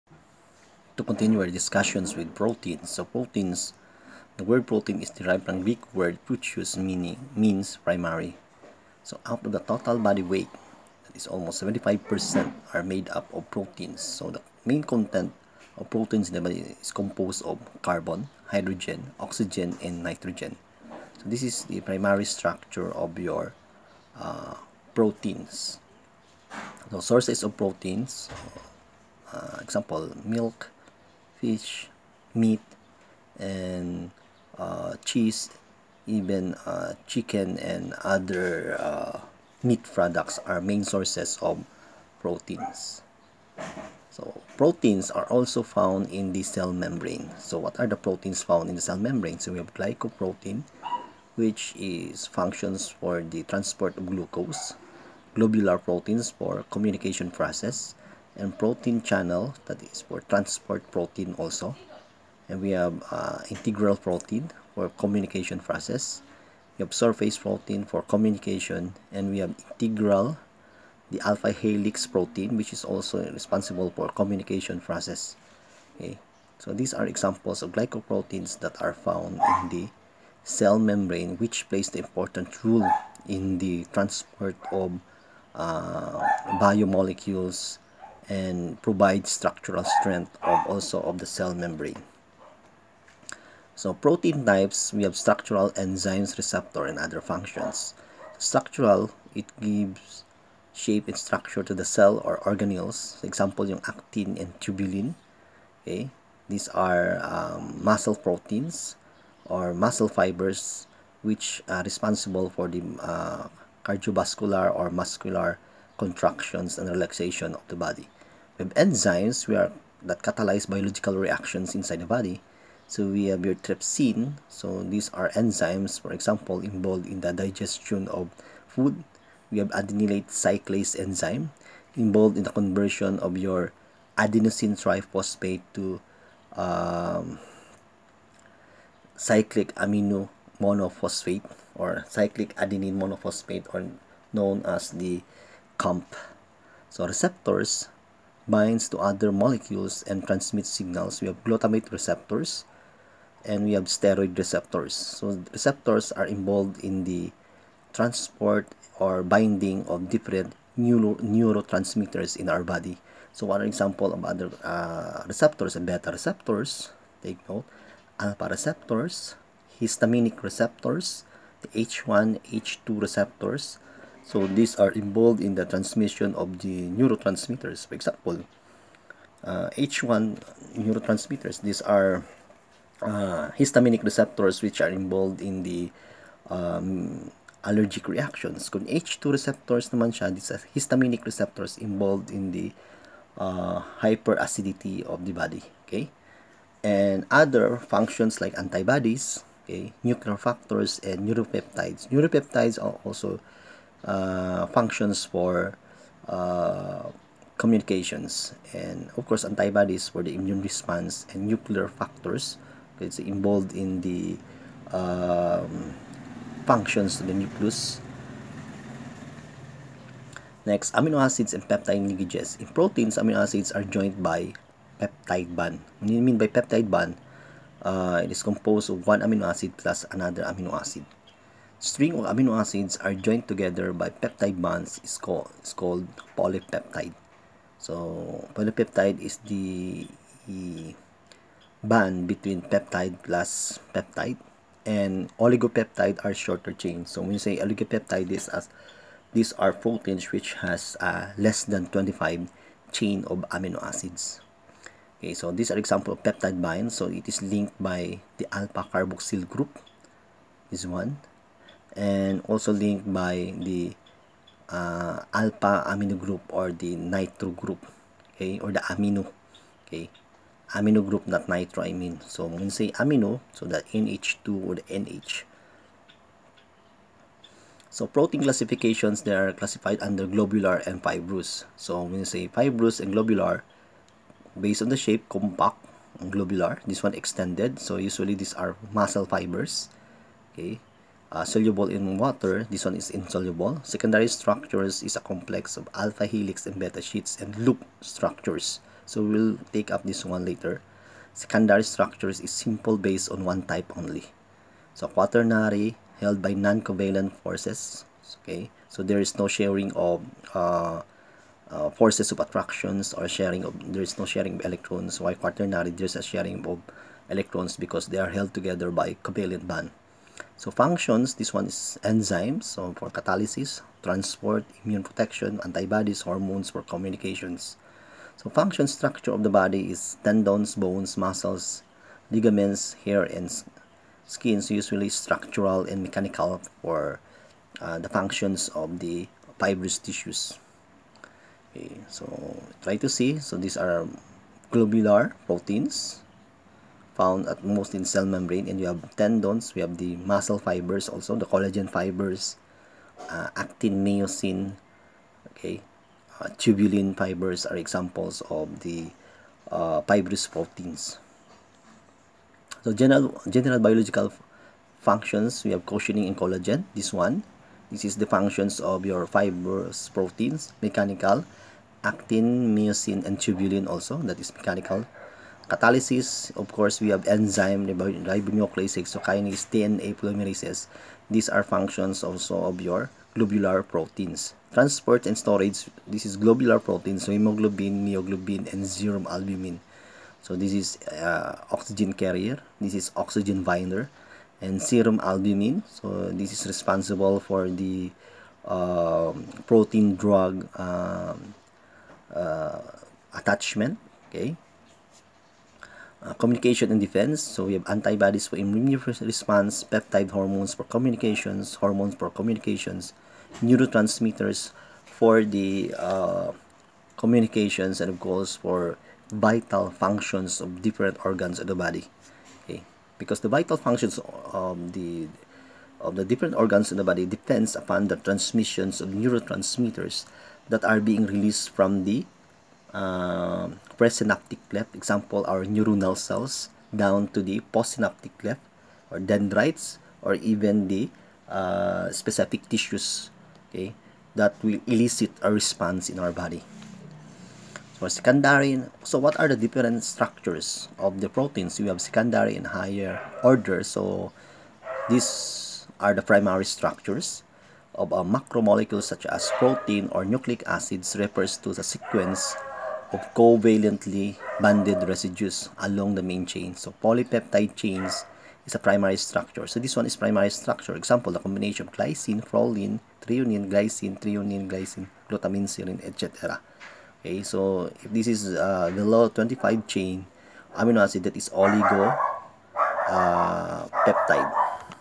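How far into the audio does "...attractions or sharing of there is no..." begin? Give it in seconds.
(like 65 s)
312 s.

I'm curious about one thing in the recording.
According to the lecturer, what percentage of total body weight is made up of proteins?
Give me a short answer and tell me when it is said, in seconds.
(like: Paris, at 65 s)
75%, at 11 s.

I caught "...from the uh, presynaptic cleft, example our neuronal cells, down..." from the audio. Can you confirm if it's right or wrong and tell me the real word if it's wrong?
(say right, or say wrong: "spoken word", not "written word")
right.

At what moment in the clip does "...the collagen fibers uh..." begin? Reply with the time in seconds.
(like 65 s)
351 s.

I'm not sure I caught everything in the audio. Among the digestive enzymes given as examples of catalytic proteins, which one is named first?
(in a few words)
trypsin.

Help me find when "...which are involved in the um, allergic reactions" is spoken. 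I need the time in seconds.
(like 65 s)
184 s.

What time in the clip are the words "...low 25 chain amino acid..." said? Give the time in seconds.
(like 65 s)
478 s.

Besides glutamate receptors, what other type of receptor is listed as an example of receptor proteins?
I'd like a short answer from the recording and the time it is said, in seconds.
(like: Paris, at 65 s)
steroid receptors, at 153 s.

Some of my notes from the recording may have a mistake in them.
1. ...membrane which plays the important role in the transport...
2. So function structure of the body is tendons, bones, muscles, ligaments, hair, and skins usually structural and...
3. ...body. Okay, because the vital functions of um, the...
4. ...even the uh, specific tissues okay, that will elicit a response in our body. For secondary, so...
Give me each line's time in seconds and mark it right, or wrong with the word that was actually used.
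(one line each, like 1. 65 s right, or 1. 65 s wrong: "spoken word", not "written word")
1. 80 s right
2. 328 s right
3. 421 s right
4. 440 s right.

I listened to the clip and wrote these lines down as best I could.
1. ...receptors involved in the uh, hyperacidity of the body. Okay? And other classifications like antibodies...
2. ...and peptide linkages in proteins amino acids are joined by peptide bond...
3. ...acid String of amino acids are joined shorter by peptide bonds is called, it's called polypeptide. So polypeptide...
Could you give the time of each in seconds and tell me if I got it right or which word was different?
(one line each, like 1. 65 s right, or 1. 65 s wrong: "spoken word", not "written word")
1. 191 s wrong: "functions", not "classifications"
2. 221 s right
3. 230 s wrong: "together", not "shorter".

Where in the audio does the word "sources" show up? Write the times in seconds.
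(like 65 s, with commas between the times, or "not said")
27 s, 40 s.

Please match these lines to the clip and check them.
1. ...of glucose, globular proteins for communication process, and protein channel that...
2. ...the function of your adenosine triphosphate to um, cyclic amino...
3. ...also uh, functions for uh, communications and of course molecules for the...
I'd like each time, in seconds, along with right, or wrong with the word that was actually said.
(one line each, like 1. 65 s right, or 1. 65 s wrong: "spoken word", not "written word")
1. 53 s right
2. 132 s wrong: "conversion", not "function"
3. 203 s wrong: "antibodies", not "molecules".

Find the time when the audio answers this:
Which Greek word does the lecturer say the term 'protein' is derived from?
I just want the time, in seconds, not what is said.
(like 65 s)
6 s.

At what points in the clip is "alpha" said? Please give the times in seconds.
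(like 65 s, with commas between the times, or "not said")
71 s, 168 s, 258 s, 265 s, 295 s.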